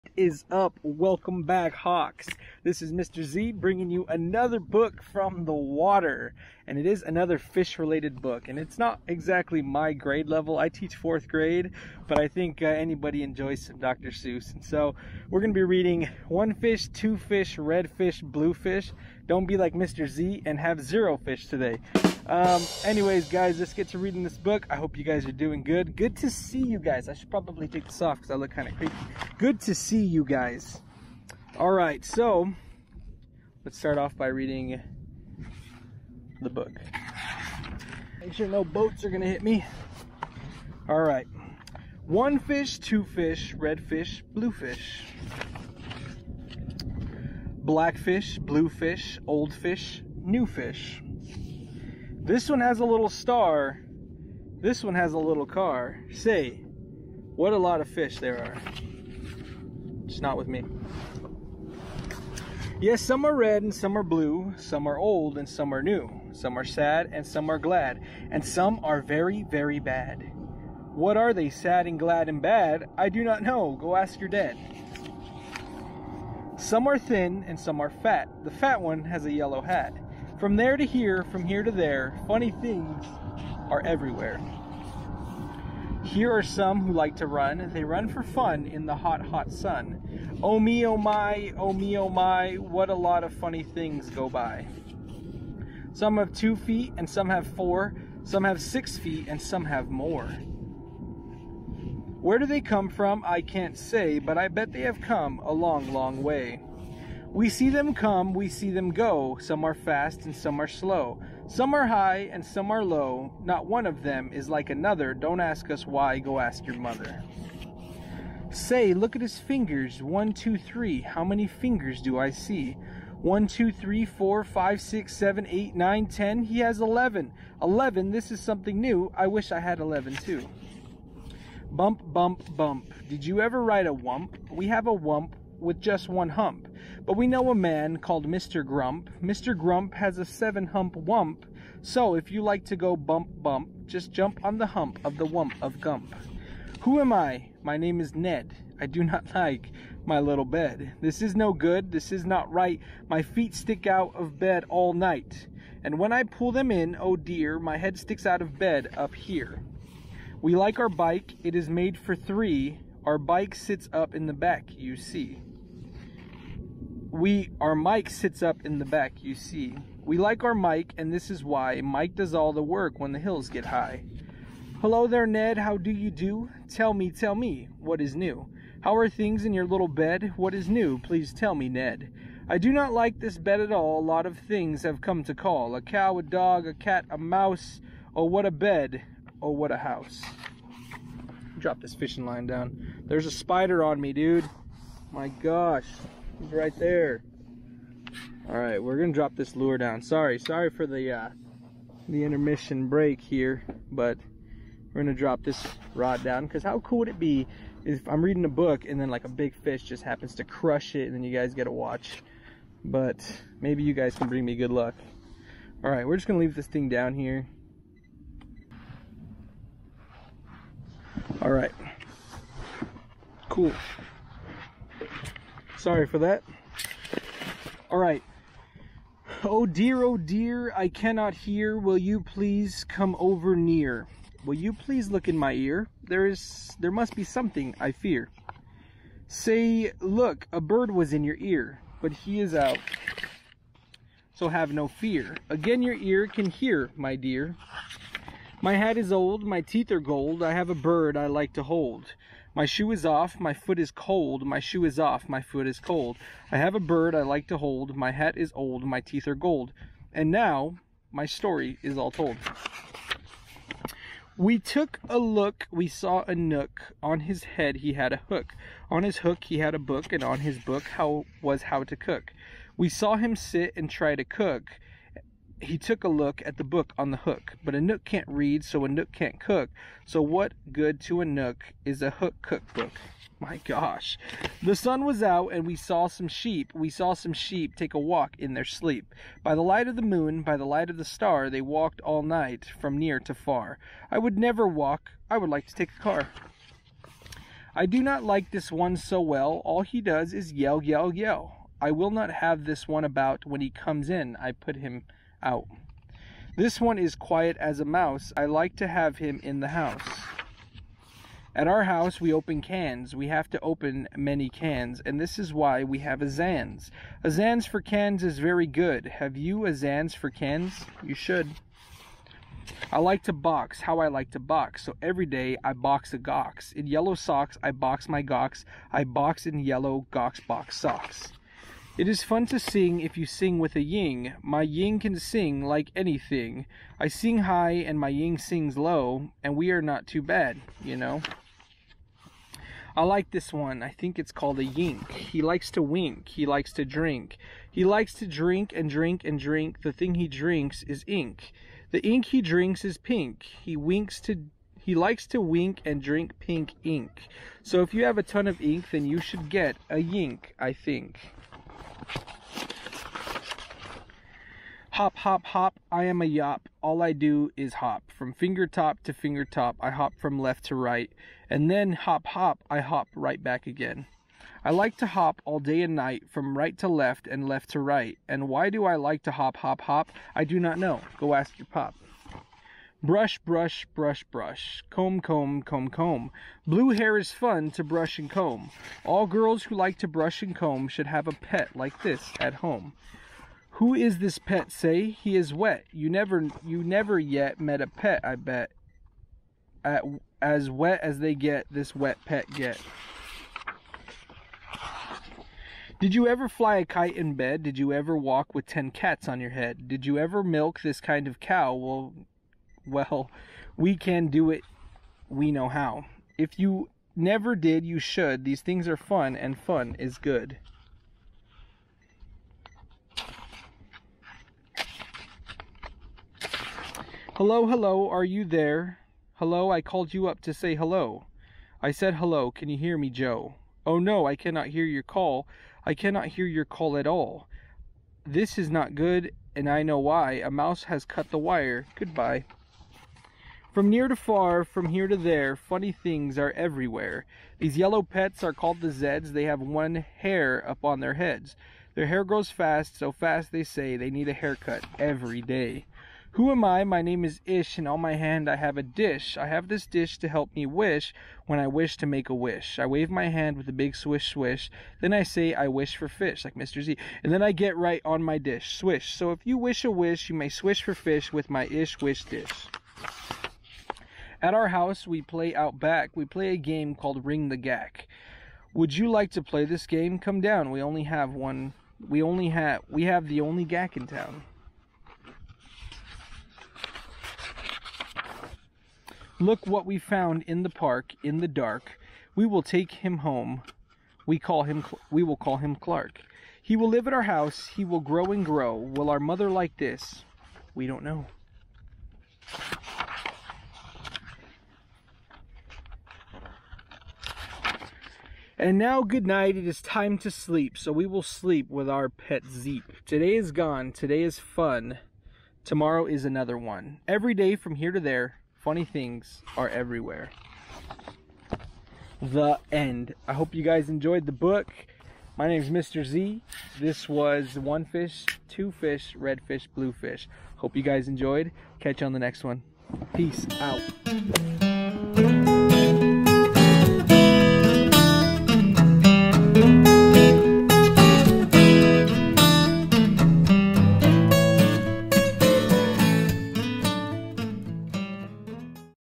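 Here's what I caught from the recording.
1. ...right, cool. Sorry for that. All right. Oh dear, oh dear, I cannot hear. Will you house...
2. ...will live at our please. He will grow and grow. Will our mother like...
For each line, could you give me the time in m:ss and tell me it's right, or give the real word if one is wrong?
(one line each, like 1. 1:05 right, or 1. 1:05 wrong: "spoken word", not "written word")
1. 3:41 wrong: "please", not "house"
2. 8:16 wrong: "house", not "please".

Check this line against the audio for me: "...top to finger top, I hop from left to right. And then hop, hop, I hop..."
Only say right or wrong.
right.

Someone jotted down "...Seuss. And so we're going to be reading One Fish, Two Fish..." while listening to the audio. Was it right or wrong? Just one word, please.
right.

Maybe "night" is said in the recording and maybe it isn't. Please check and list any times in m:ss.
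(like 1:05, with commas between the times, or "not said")
2:34, 4:52, 6:15, 8:29.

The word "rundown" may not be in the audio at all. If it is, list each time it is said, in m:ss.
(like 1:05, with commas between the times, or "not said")
not said.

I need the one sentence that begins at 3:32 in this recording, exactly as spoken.
But maybe you guys can bring me good luck.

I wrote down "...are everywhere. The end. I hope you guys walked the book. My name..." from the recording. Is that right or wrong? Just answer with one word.
wrong.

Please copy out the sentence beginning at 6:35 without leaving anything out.
You never you never yet met a pet, I bet.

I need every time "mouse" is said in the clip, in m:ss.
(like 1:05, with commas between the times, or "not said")
3:07, 5:07, 7:20.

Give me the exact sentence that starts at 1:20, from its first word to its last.
From there to here, from here to there, funny things are everywhere.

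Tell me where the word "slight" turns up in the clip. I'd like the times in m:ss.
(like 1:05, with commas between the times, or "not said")
not said.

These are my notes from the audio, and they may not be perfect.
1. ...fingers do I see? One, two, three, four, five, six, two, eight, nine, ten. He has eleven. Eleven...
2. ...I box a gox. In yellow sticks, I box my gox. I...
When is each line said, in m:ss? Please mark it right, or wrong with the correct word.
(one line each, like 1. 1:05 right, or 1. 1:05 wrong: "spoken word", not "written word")
1. 2:01 wrong: "seven", not "two"
2. 5:25 wrong: "socks", not "sticks".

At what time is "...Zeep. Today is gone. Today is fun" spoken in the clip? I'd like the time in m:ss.
8:32.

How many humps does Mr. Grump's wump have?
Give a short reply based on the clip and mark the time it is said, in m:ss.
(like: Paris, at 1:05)
7, at 2:20.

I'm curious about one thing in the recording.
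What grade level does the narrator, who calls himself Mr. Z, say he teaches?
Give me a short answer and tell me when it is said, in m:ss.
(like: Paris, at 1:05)
fourth grade, at 0:10.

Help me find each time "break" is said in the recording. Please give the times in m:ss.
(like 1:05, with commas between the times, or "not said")
3:22.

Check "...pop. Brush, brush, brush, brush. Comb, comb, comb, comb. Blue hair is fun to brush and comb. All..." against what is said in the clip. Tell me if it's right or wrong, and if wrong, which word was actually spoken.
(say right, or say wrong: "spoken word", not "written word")
right.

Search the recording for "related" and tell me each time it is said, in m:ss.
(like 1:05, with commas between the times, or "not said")
0:07.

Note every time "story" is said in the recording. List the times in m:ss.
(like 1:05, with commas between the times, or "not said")
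4:21.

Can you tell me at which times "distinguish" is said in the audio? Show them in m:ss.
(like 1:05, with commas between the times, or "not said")
not said.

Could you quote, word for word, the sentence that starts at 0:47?
Black fish, blue fish, old fish, new fish.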